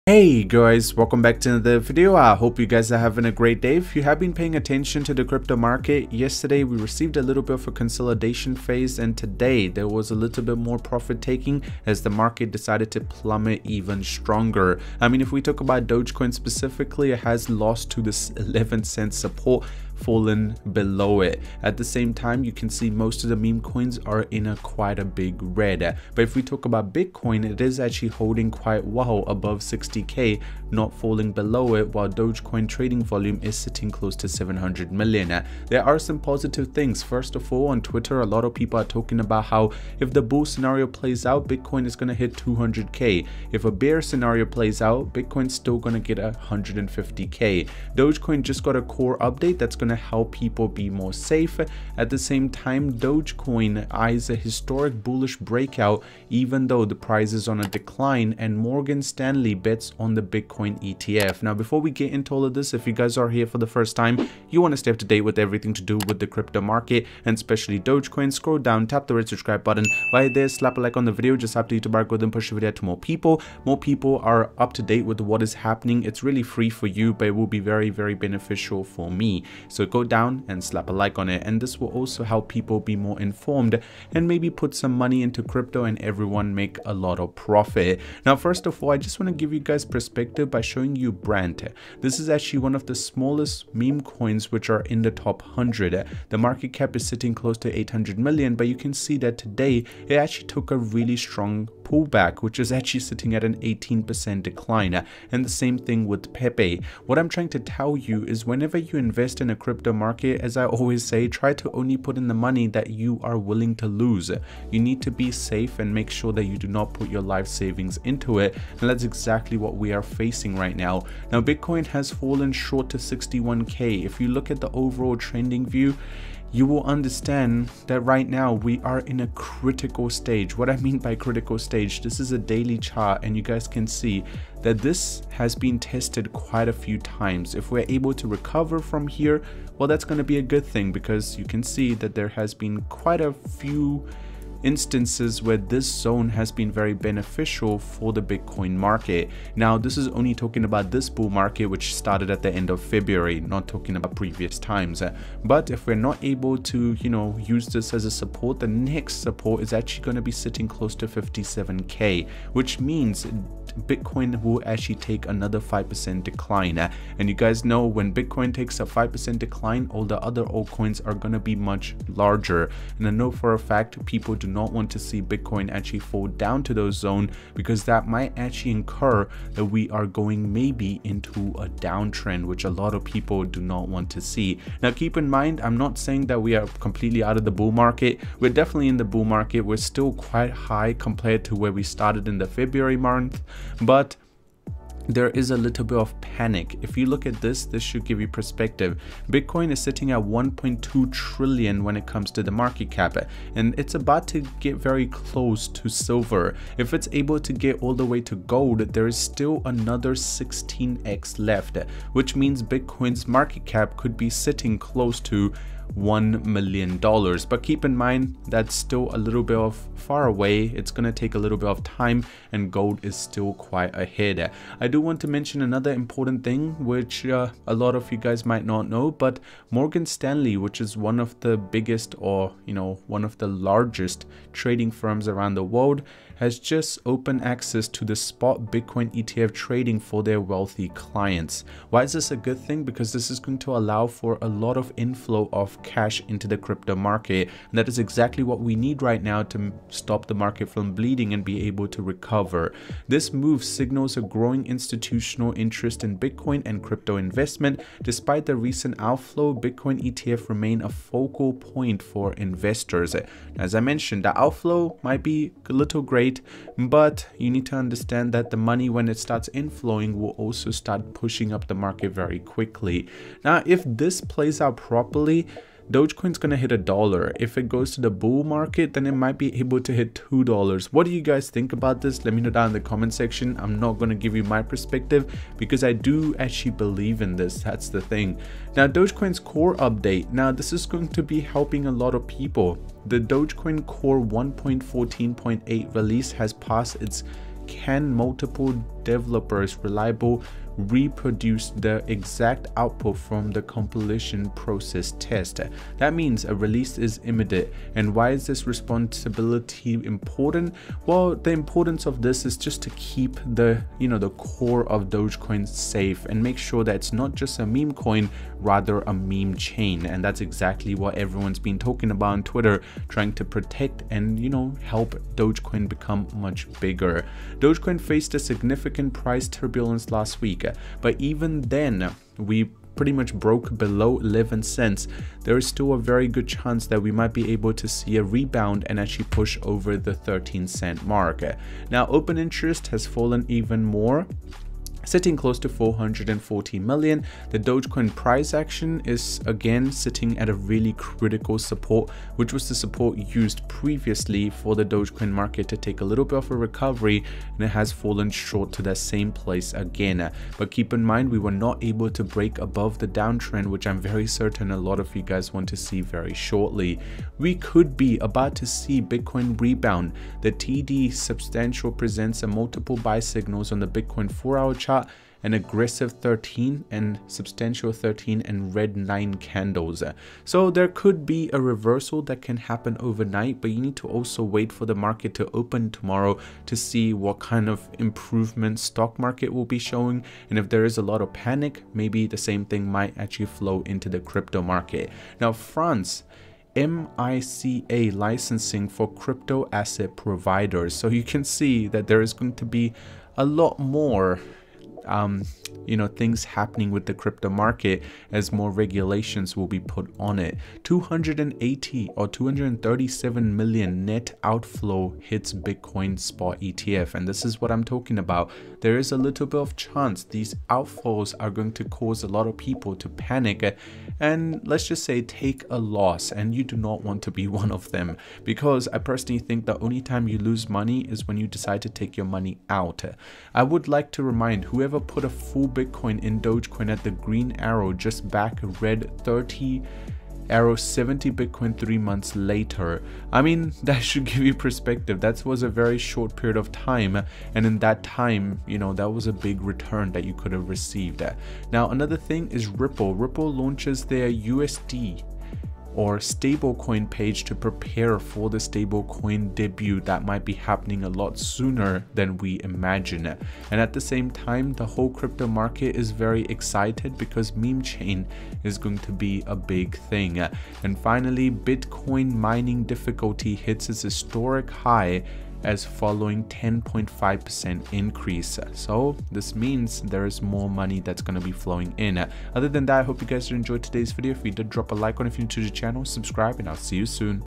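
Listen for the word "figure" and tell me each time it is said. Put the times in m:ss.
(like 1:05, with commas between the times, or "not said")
not said.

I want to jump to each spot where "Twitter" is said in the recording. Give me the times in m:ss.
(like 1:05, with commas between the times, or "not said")
0:37, 5:22.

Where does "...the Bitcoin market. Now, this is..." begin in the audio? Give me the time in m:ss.
2:28.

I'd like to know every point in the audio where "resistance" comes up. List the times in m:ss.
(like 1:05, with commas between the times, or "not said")
not said.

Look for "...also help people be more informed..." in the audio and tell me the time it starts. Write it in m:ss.
1:21.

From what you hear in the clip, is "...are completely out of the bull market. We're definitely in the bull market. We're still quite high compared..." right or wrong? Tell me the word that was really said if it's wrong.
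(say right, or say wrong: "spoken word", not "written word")
right.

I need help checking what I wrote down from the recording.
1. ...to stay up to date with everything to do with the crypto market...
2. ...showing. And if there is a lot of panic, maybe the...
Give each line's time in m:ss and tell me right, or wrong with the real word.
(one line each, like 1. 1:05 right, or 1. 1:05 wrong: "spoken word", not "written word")
1. 1:04 right
2. 6:29 right.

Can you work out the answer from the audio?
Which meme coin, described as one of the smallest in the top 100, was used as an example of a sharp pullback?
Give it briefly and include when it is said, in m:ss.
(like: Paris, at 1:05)
Brandt, at 1:31.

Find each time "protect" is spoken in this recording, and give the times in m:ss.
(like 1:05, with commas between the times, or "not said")
5:23.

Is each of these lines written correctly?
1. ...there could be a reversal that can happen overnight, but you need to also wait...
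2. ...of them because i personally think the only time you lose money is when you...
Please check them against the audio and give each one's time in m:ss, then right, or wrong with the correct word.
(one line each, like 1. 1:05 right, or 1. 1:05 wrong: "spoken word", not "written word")
1. 6:20 right
2. 7:07 right.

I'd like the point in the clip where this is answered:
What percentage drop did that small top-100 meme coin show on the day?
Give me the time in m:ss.
1:43.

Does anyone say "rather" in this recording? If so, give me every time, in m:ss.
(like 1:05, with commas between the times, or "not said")
5:18.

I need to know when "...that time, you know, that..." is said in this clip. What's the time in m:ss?
7:27.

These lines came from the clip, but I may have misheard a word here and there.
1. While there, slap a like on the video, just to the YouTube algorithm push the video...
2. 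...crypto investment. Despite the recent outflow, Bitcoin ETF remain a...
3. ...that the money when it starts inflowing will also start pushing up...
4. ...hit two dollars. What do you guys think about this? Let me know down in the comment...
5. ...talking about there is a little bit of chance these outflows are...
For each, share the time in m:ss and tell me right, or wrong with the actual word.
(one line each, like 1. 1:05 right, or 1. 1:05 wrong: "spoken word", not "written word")
1. 1:10 right
2. 4:16 right
3. 4:28 right
4. 4:39 right
5. 6:57 right.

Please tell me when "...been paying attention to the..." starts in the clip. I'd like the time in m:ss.
0:04.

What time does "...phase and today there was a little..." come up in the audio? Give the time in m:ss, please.
0:08.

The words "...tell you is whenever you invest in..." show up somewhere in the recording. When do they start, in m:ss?
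1:47.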